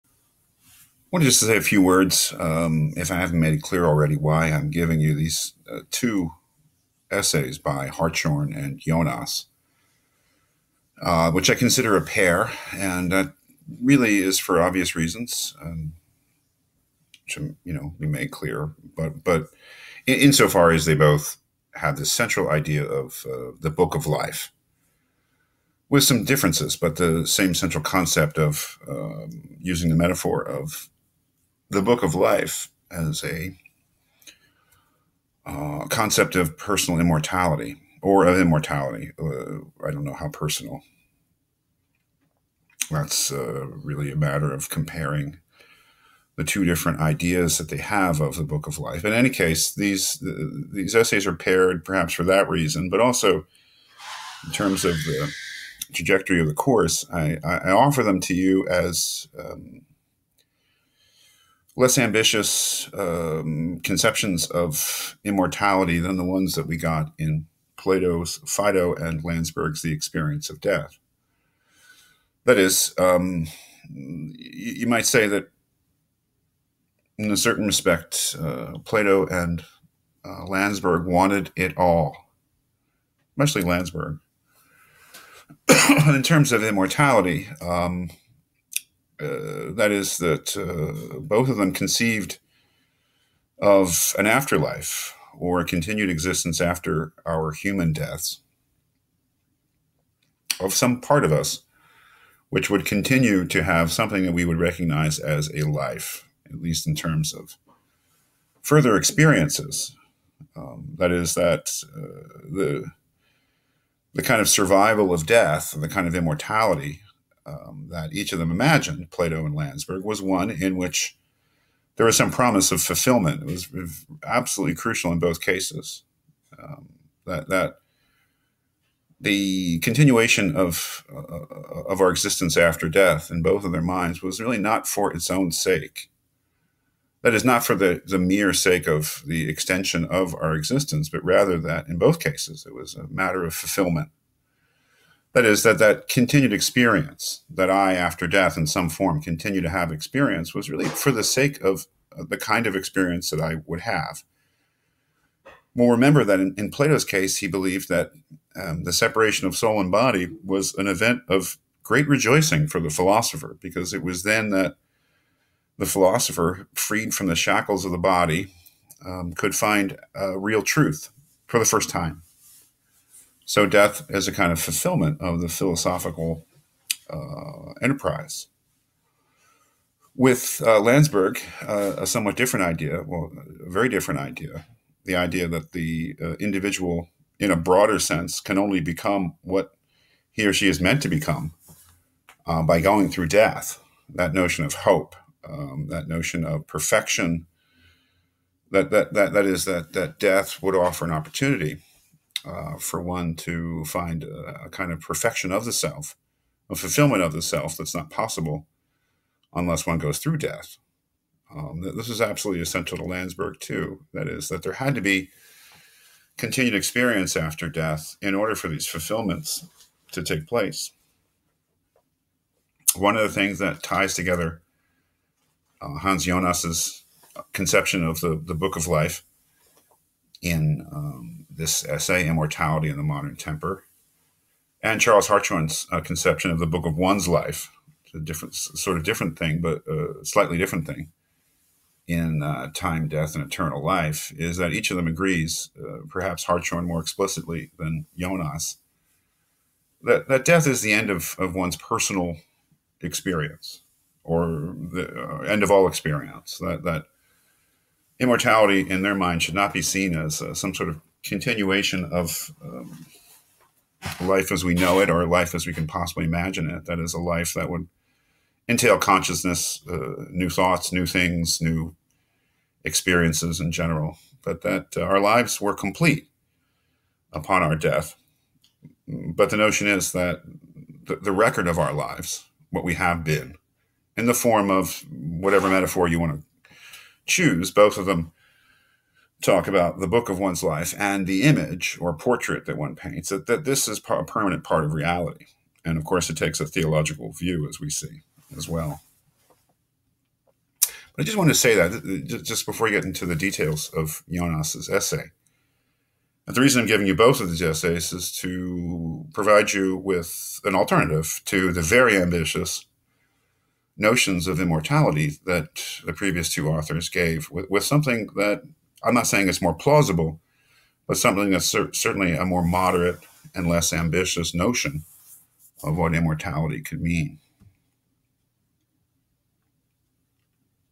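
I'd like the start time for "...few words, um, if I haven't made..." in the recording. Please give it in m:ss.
0:01.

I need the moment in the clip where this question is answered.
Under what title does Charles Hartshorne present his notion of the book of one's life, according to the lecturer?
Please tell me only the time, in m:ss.
4:02.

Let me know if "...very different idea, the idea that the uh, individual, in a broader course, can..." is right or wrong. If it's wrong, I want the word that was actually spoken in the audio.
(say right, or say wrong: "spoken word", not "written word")
wrong: "sense", not "course".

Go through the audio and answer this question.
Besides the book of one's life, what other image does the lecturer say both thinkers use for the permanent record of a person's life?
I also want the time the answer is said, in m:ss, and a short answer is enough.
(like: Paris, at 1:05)
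portrait, at 4:52.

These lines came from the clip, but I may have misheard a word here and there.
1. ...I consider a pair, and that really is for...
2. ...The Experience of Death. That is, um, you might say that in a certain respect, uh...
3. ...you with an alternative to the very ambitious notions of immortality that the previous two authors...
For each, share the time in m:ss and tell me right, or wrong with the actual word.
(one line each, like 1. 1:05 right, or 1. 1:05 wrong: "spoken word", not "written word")
1. 0:11 right
2. 1:09 right
3. 5:09 right.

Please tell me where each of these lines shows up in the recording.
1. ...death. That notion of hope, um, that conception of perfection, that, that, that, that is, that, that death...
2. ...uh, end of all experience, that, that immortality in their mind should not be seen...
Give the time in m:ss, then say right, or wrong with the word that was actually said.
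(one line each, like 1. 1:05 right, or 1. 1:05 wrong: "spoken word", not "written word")
1. 3:13 wrong: "notion", not "conception"
2. 4:15 right.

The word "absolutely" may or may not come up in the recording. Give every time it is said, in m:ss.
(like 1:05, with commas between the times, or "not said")
2:04, 3:32.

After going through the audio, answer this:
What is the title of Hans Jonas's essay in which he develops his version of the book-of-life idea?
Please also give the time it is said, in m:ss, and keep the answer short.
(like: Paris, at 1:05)
Immortality in the Modern Temper, at 3:52.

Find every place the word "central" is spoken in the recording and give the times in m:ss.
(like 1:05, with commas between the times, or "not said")
0:22, 0:27.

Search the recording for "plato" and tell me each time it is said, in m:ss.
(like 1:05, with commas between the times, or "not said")
1:07, 1:18, 1:59, 2:36.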